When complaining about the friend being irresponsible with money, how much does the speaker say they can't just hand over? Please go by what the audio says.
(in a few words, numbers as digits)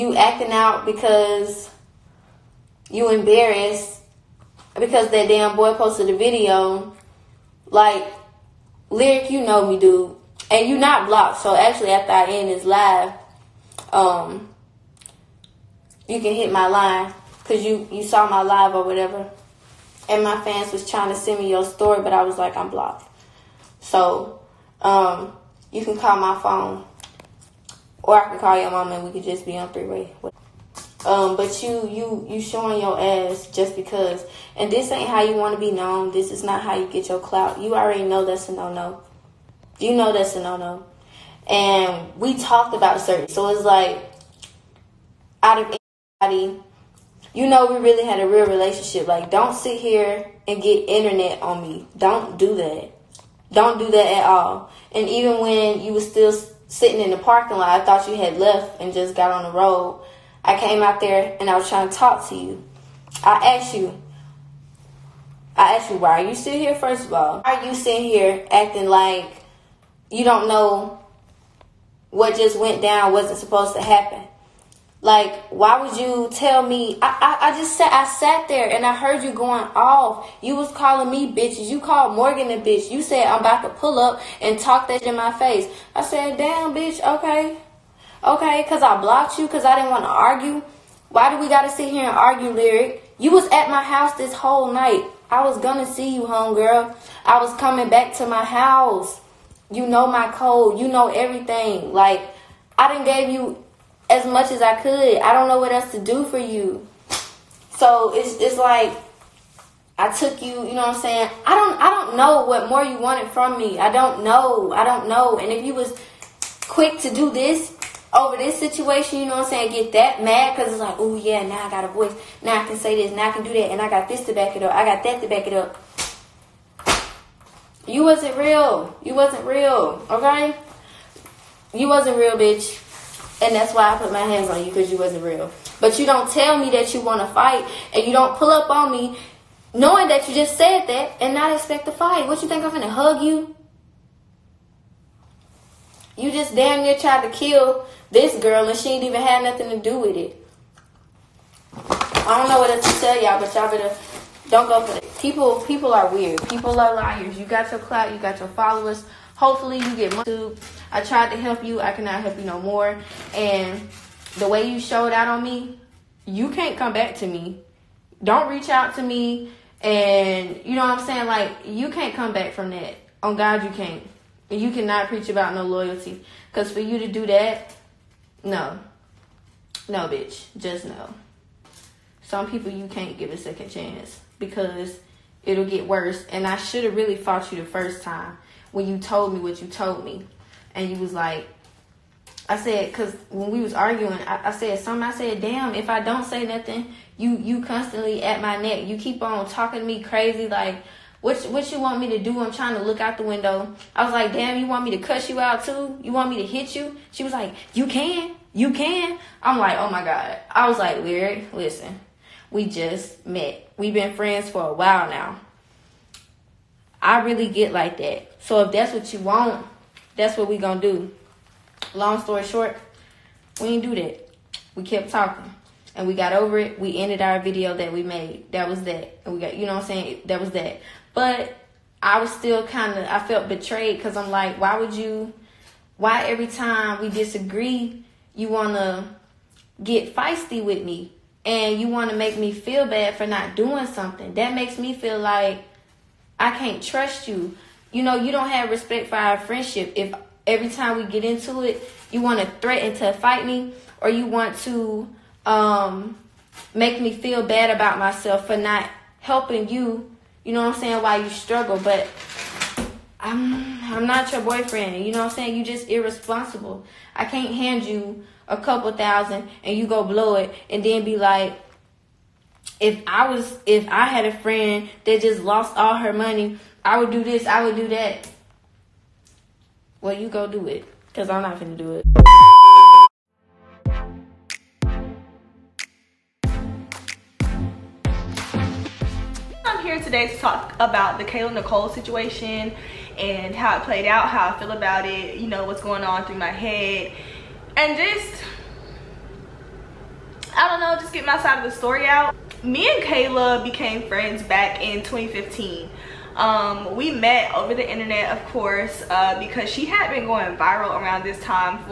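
A couple thousand.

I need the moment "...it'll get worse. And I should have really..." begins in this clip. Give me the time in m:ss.
3:05.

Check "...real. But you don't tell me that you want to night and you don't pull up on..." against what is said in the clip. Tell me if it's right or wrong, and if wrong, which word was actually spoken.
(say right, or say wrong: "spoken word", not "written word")
wrong: "fight", not "night".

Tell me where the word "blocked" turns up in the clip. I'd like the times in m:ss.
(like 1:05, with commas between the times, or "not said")
0:11, 0:22, 1:28.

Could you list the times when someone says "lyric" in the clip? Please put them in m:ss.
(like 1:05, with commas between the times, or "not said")
0:08, 1:32, 3:31.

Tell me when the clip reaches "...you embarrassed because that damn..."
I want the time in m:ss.
0:02.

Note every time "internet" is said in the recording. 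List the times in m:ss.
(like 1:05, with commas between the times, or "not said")
0:50, 5:07.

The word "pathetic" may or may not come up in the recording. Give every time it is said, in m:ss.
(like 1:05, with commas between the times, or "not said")
not said.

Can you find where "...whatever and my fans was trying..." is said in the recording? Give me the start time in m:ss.
0:18.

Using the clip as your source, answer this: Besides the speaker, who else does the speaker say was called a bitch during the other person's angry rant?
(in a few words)
Morgan.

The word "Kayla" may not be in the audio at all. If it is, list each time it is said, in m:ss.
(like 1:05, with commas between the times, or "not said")
4:51, 5:03.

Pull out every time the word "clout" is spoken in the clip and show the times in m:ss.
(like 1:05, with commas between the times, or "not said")
0:37, 2:37.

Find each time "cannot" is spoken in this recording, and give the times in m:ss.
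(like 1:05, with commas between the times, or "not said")
2:41, 2:54.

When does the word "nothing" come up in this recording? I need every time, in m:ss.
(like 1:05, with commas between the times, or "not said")
2:29, 3:16.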